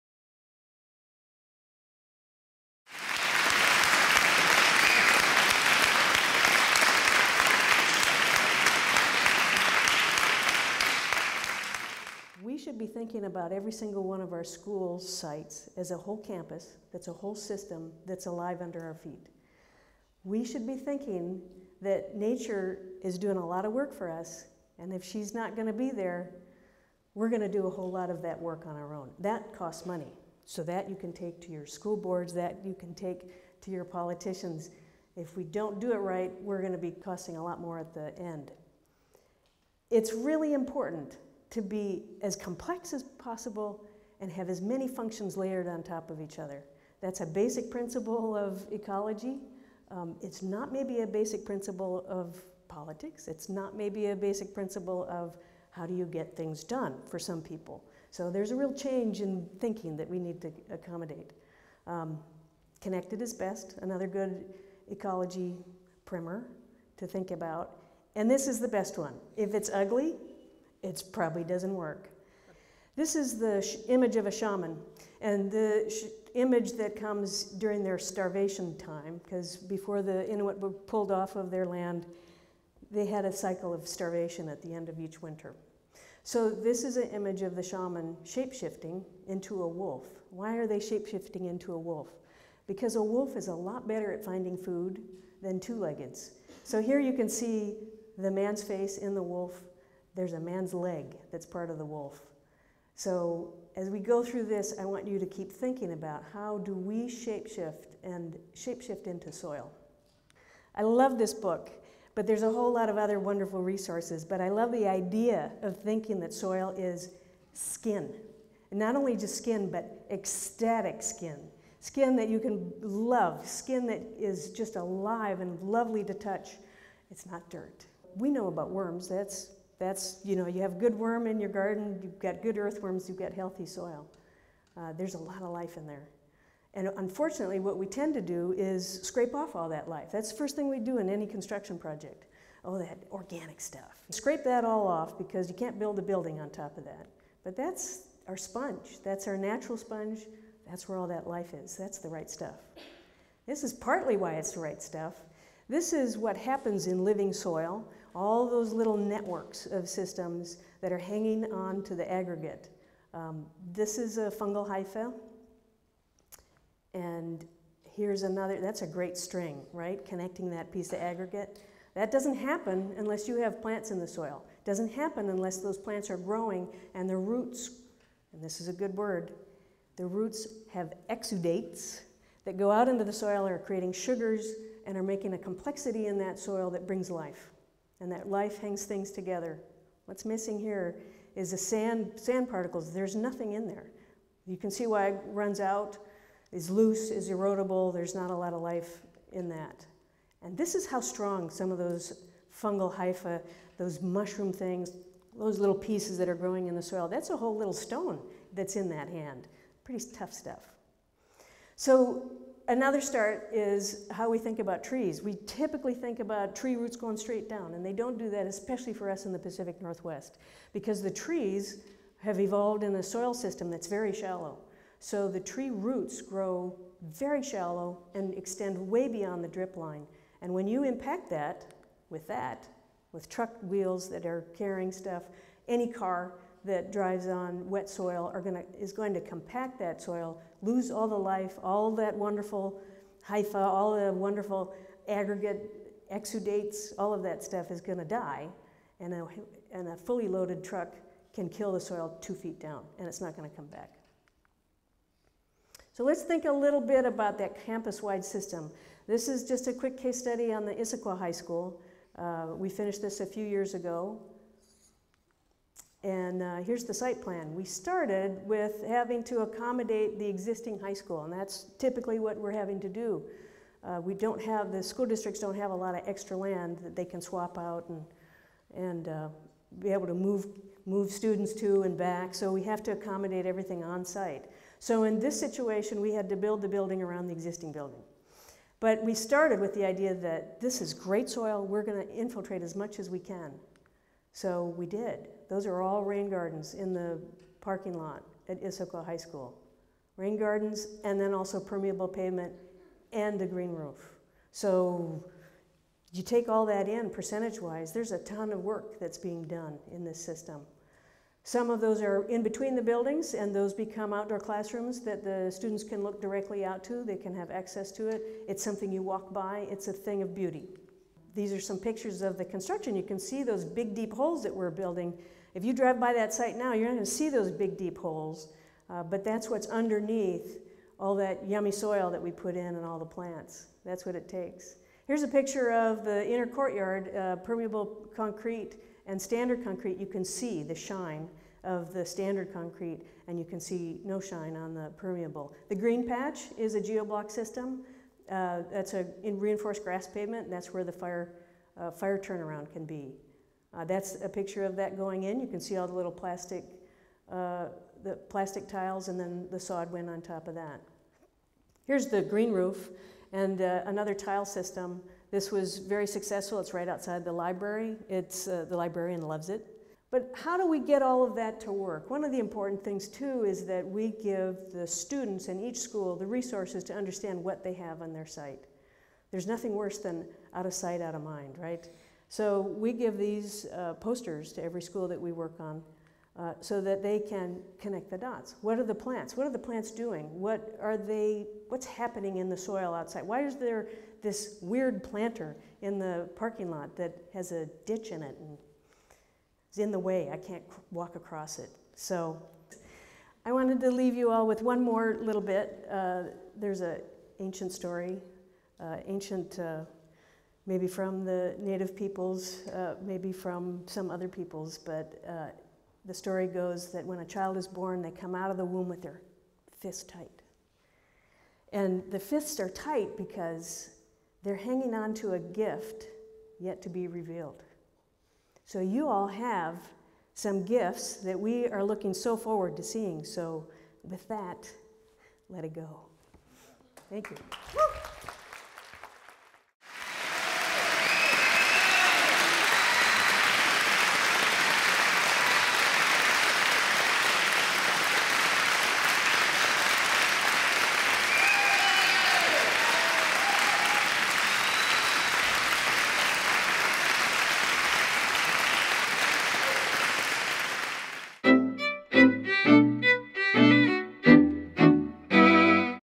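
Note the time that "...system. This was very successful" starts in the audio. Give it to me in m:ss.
6:04.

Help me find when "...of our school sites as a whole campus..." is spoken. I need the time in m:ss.
0:14.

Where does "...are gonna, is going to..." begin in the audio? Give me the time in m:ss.
3:58.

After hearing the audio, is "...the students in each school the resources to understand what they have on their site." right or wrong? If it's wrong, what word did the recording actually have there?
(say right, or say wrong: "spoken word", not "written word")
right.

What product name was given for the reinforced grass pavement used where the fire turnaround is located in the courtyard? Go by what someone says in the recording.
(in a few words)
Geoblock.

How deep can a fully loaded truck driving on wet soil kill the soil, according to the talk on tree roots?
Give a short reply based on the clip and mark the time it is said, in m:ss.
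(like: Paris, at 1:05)
2 feet, at 4:12.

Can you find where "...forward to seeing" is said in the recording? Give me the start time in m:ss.
7:12.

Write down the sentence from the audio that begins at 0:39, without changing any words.
It's really important to be as complex as possible and have as many functions layered on top of each other.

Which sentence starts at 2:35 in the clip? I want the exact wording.
This is what happens in living soil all those little networks of systems that are hanging on to the aggregate.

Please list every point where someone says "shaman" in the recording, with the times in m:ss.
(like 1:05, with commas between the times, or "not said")
1:14, 1:27.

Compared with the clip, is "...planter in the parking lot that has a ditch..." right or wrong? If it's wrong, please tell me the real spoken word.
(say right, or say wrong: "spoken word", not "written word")
right.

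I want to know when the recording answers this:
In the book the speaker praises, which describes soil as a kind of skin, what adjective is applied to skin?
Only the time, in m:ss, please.
2:00.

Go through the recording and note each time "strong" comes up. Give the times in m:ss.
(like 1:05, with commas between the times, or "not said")
3:20.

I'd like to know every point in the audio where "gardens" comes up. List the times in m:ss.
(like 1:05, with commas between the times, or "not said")
2:11, 4:56, 5:00.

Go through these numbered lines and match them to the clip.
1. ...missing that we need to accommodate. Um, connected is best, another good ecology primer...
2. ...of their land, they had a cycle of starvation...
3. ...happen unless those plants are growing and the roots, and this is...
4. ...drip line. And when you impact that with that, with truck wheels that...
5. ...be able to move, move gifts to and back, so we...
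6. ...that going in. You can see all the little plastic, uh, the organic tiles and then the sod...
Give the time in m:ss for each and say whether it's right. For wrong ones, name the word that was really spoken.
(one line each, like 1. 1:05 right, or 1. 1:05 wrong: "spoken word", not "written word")
1. 0:59 wrong: "thinking", not "missing"
2. 1:21 right
3. 2:54 right
4. 3:49 right
5. 4:39 wrong: "students", not "gifts"
6. 5:54 wrong: "plastic", not "organic".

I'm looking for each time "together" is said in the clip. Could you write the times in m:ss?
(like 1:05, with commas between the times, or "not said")
3:09.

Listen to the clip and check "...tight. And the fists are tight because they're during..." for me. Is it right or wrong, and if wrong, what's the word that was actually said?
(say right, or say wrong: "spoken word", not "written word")
wrong: "hanging", not "during".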